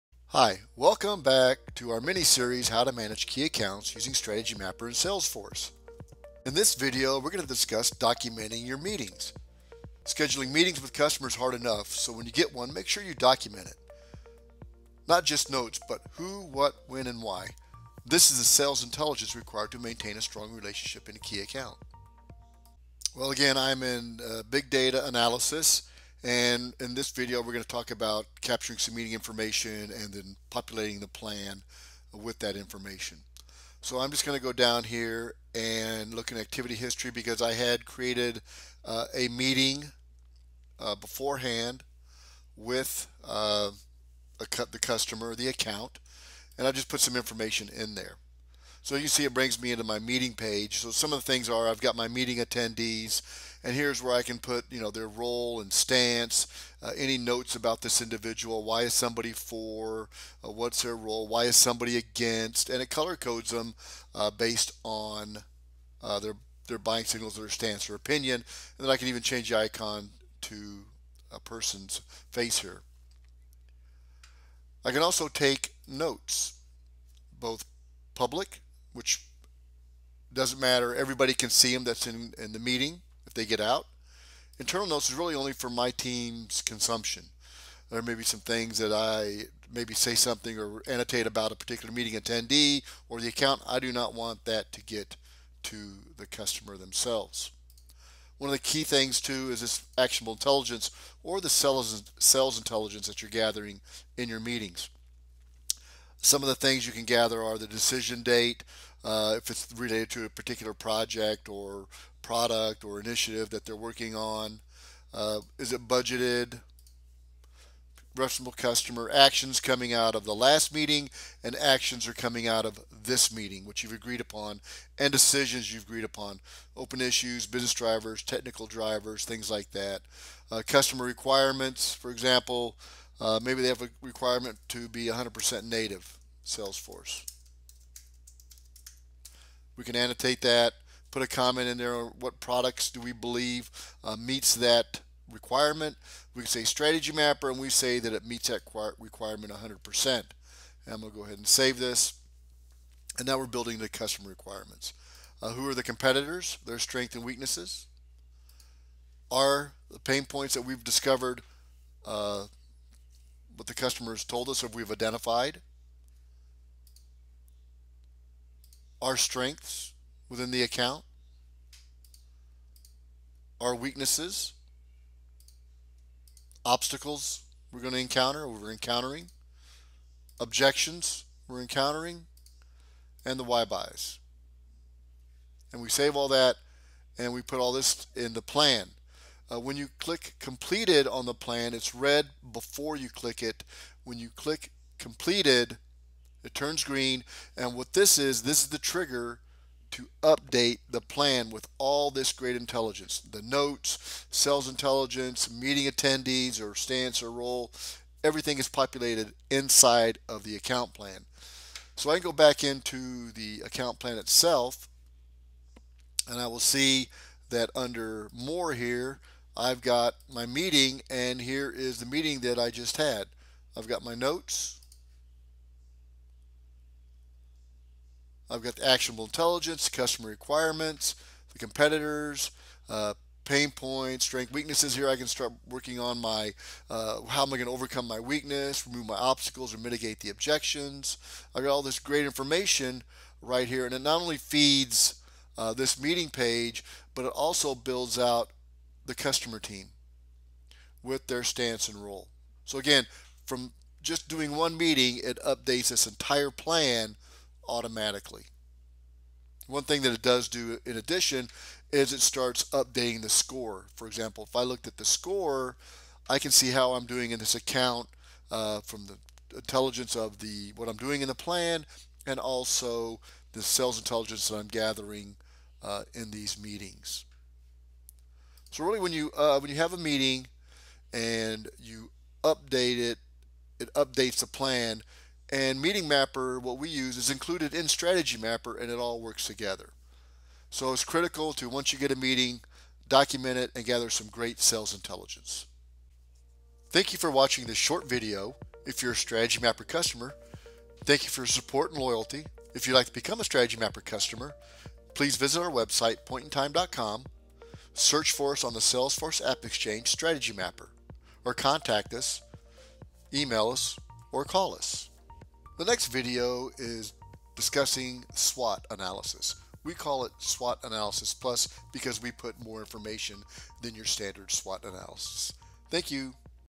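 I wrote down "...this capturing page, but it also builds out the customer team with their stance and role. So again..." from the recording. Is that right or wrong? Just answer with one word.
wrong.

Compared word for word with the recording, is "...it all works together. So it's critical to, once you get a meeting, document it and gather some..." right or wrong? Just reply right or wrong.
right.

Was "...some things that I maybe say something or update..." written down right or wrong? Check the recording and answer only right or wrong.
wrong.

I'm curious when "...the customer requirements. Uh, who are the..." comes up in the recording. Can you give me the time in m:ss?
2:33.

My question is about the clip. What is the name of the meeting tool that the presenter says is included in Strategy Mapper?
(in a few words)
Meeting Mapper.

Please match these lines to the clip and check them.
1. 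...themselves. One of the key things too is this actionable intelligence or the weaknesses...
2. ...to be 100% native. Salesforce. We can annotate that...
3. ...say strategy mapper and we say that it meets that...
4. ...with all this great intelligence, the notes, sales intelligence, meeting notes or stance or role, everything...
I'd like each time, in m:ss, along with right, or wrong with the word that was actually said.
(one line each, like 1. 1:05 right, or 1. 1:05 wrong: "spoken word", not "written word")
1. 1:36 wrong: "sales", not "weaknesses"
2. 2:14 right
3. 2:26 right
4. 3:21 wrong: "attendees", not "notes".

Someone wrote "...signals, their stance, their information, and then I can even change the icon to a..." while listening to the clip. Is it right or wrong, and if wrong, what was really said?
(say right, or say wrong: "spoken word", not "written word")
wrong: "opinion", not "information".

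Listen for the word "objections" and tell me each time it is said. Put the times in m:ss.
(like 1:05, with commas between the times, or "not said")
3:00, 4:00.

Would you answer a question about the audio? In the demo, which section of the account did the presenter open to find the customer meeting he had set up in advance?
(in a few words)
Activity history.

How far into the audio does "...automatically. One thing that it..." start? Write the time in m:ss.
4:17.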